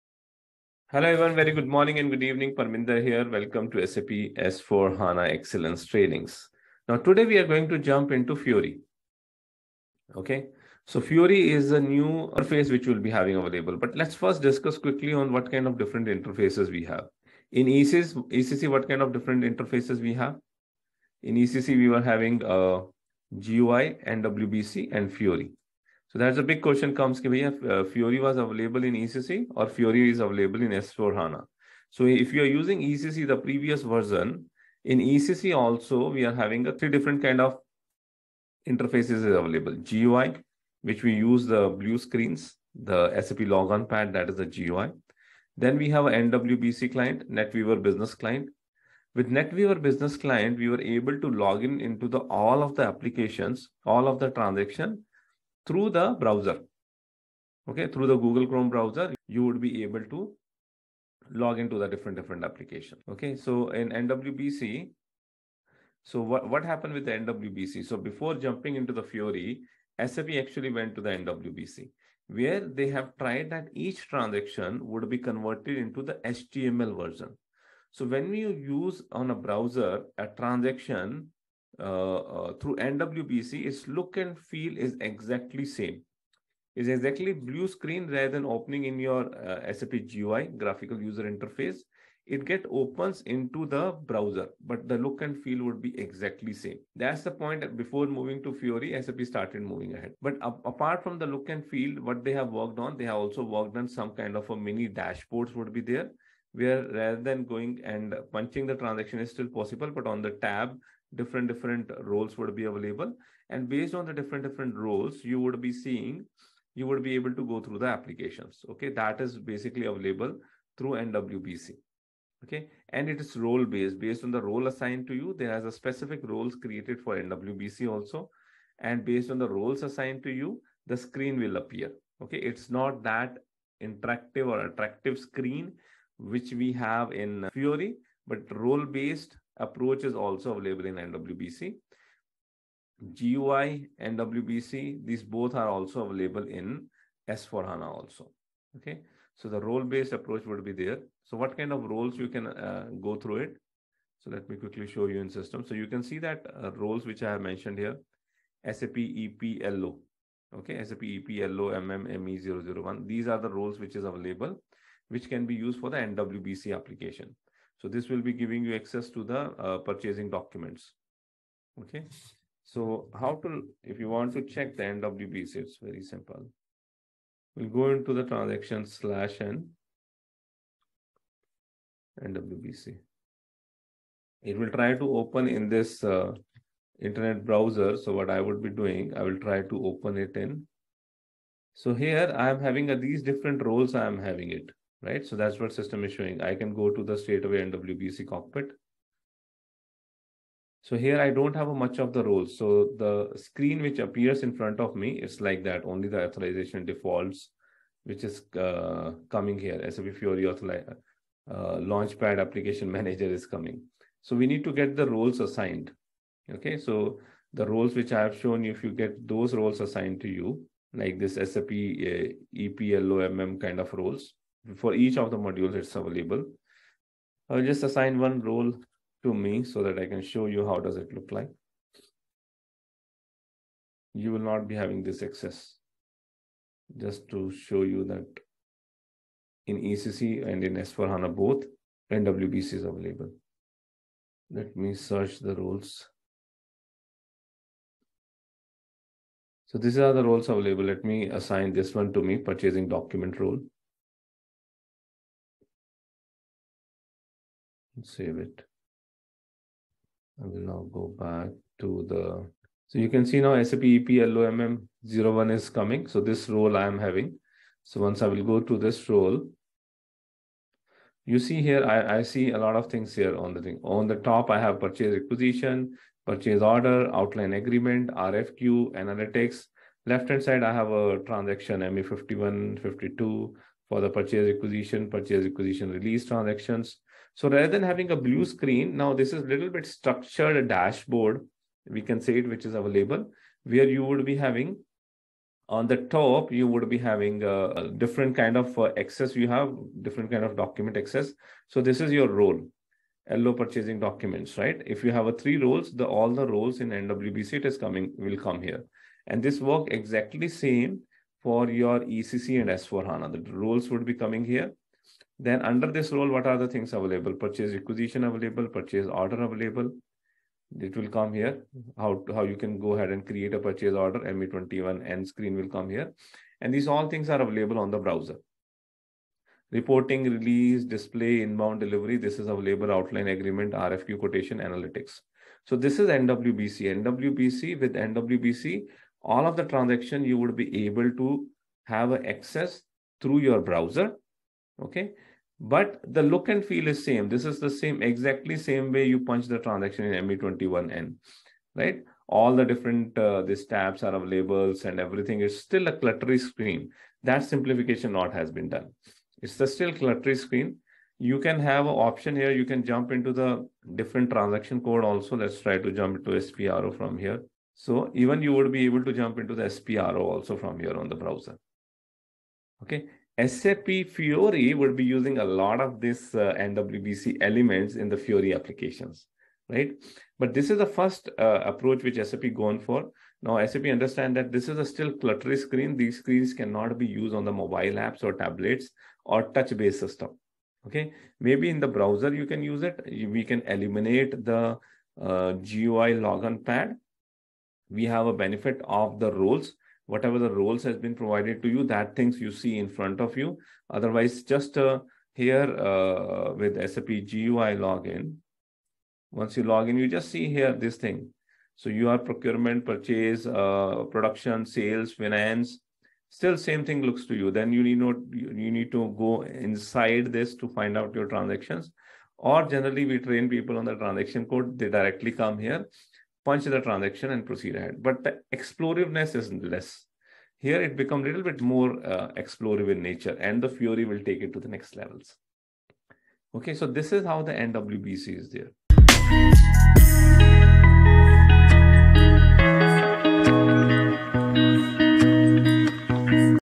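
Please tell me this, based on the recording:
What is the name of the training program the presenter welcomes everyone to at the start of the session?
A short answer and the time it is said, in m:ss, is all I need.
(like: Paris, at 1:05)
SAP S4 HANA Excellence Trainings, at 0:03.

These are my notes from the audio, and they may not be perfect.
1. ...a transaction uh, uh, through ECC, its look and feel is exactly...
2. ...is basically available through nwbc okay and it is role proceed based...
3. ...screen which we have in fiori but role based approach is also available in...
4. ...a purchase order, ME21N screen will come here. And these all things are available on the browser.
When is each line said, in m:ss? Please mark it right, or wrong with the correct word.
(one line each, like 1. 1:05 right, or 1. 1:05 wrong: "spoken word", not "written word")
1. 1:20 wrong: "NWBC", not "ECC"
2. 1:59 wrong: "based", not "proceed"
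3. 2:15 right
4. 5:23 right.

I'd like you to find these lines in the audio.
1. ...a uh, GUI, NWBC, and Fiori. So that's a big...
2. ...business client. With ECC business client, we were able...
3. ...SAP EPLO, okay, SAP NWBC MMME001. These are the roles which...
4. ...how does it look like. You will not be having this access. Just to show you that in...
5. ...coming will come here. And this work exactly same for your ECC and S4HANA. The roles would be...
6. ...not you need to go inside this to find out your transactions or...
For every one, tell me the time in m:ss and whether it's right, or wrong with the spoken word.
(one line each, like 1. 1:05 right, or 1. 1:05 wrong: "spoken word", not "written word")
1. 0:22 right
2. 0:47 wrong: "NetWeaver", not "ECC"
3. 2:38 wrong: "EPLO", not "NWBC"
4. 3:50 right
5. 5:07 right
6. 6:58 right.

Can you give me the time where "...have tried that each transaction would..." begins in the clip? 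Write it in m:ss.
1:12.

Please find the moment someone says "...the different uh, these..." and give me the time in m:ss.
5:52.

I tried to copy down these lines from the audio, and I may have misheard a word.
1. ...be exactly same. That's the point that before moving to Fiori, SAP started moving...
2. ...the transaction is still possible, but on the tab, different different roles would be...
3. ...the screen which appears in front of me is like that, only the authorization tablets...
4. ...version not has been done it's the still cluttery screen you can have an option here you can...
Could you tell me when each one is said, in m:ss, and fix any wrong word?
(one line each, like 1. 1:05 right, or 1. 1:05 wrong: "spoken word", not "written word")
1. 1:35 right
2. 1:48 right
3. 3:22 wrong: "defaults", not "tablets"
4. 5:57 wrong: "simplification", not "version".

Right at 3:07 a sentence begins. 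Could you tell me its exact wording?
So what I would be doing, I will try to open it in.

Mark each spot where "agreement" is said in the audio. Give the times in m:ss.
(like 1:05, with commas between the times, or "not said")
4:37, 5:33.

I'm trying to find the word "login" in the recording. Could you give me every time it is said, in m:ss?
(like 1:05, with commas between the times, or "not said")
6:47.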